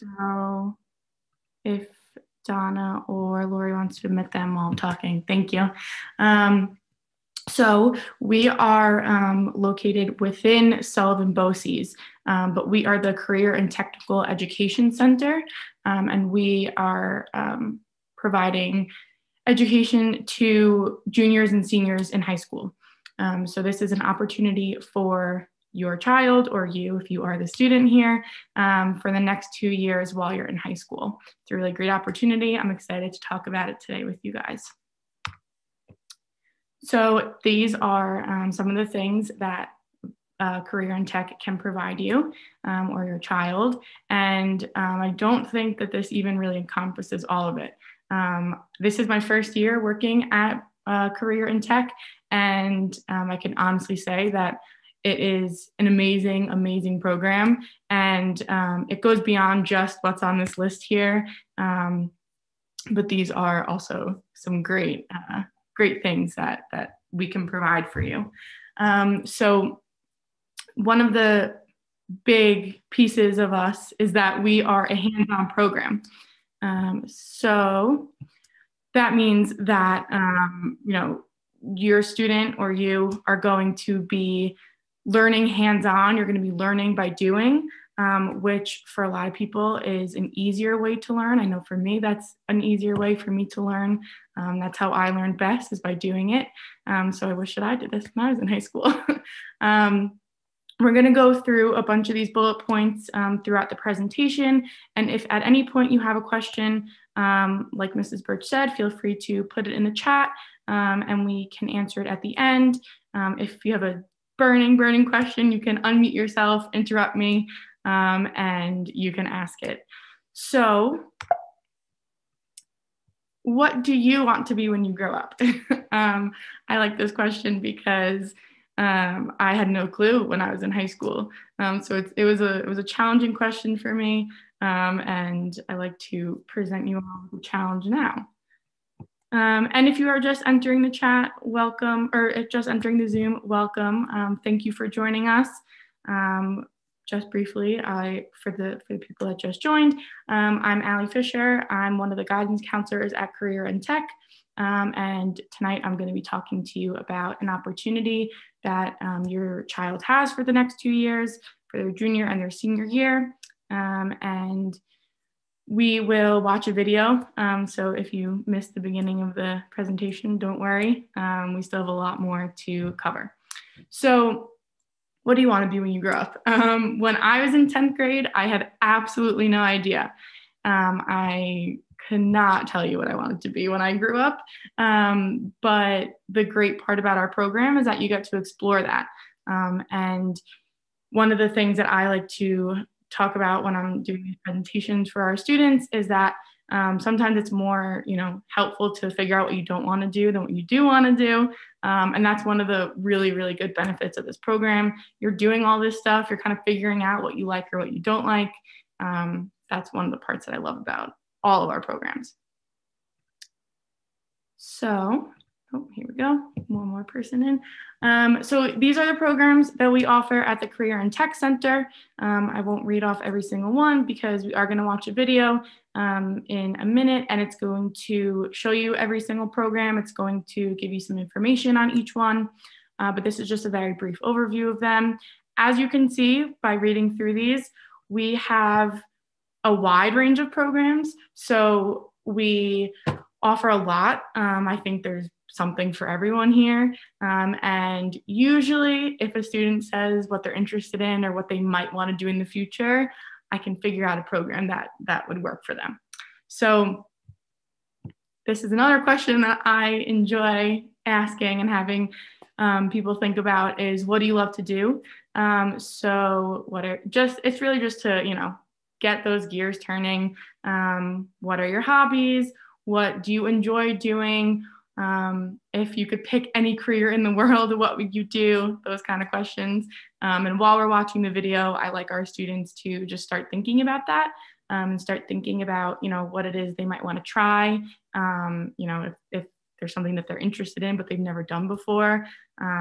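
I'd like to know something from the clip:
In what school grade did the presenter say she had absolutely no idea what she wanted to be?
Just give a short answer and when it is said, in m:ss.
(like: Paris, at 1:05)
10th grade, at 2:57.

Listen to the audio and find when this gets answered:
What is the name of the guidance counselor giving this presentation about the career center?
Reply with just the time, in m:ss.
2:30.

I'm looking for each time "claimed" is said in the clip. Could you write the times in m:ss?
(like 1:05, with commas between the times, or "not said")
not said.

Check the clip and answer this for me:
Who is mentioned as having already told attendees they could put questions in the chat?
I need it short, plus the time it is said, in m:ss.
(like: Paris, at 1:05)
Mrs. Birch, at 1:47.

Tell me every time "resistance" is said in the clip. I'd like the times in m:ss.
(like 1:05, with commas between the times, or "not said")
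not said.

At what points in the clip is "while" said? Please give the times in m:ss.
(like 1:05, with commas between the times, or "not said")
0:04, 0:30, 4:40.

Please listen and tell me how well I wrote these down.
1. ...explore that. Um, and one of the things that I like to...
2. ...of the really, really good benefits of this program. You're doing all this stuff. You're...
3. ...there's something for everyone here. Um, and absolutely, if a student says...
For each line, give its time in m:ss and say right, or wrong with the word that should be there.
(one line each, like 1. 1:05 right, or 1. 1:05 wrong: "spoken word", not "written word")
1. 3:08 right
2. 3:22 right
3. 4:05 wrong: "usually", not "absolutely".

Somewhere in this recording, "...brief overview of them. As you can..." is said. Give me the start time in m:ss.
3:53.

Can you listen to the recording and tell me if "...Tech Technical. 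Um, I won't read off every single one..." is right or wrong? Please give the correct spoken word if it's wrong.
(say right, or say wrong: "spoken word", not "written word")
wrong: "Center", not "Technical".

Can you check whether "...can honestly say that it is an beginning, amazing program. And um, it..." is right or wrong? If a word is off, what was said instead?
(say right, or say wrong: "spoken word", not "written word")
wrong: "amazing", not "beginning".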